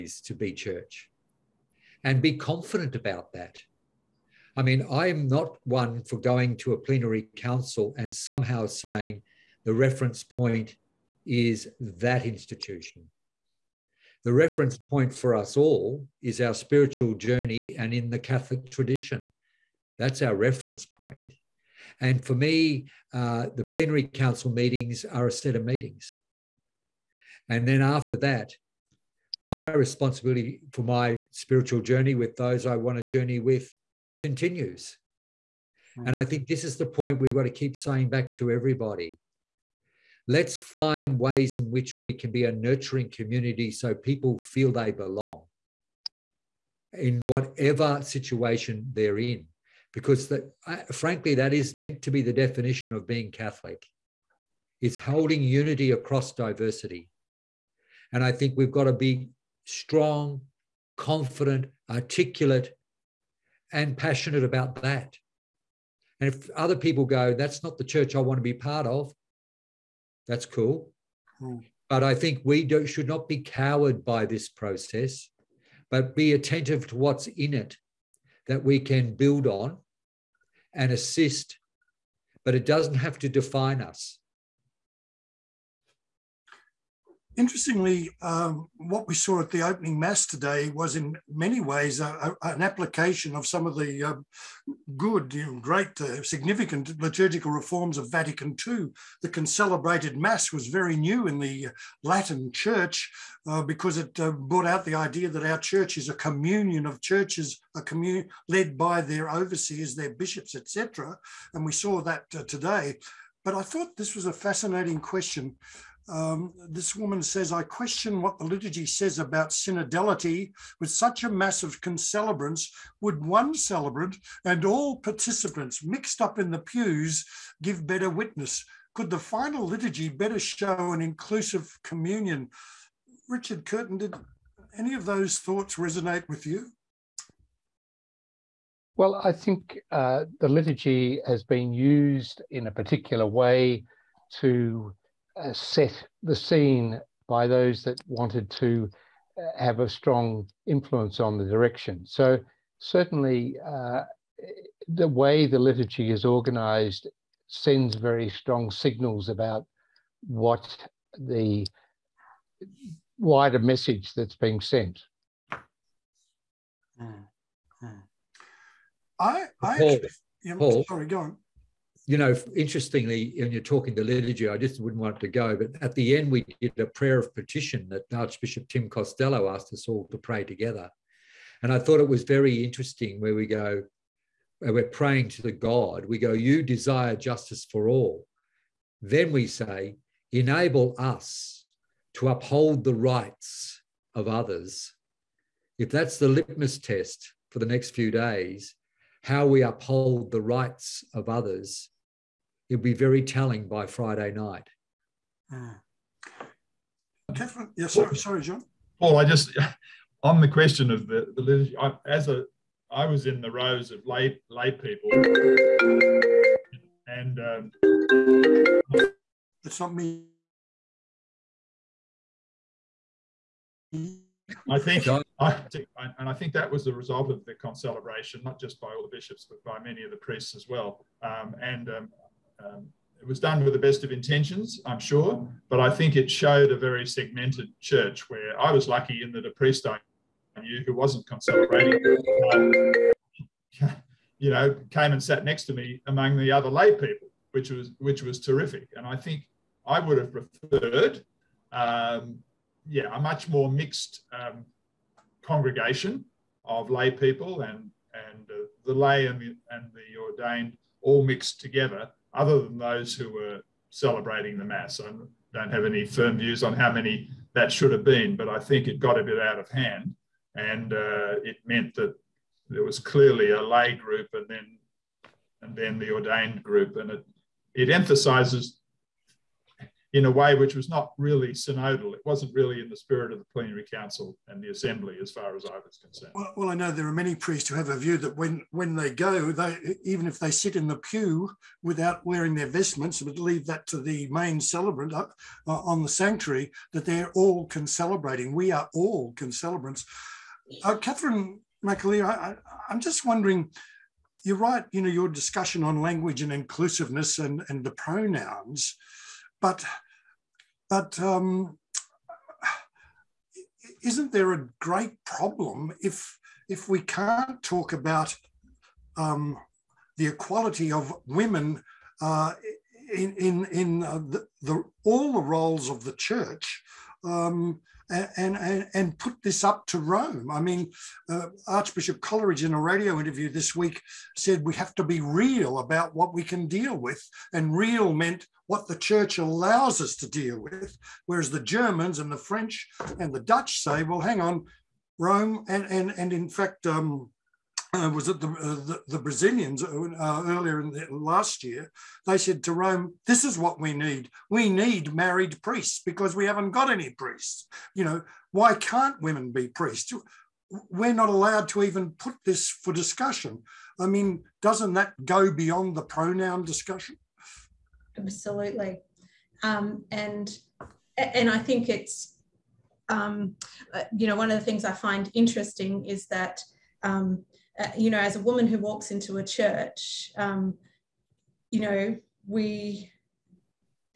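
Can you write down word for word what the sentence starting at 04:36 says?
And it, it emphasizes in a way which was not really synodal.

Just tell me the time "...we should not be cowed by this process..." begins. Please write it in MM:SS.
01:12.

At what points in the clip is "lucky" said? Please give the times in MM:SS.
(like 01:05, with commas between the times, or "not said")
03:58.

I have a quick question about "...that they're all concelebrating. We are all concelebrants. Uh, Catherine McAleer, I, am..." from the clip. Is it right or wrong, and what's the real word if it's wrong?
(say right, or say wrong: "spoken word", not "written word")
right.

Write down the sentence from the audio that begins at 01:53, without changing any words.
But I thought this was a fascinating question um, this woman says, I question what the liturgy says about synodality.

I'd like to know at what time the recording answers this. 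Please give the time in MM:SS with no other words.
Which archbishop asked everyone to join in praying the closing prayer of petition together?
02:58.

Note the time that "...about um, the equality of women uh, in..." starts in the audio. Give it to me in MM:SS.
05:17.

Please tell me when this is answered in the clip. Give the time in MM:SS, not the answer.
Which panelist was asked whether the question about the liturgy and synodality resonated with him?
02:13.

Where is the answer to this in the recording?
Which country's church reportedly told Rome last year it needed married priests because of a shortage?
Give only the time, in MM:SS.
05:49.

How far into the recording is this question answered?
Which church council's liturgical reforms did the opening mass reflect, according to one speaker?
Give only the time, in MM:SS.
01:38.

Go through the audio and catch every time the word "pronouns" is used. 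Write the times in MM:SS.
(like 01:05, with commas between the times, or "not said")
05:07, 06:06.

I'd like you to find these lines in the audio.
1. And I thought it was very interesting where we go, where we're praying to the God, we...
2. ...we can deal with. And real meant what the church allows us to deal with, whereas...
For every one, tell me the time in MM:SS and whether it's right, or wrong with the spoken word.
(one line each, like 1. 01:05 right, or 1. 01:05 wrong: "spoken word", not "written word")
1. 03:01 right
2. 05:36 right.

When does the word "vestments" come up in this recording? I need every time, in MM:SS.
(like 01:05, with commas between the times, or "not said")
04:52.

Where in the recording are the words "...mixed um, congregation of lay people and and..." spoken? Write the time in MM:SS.
04:13.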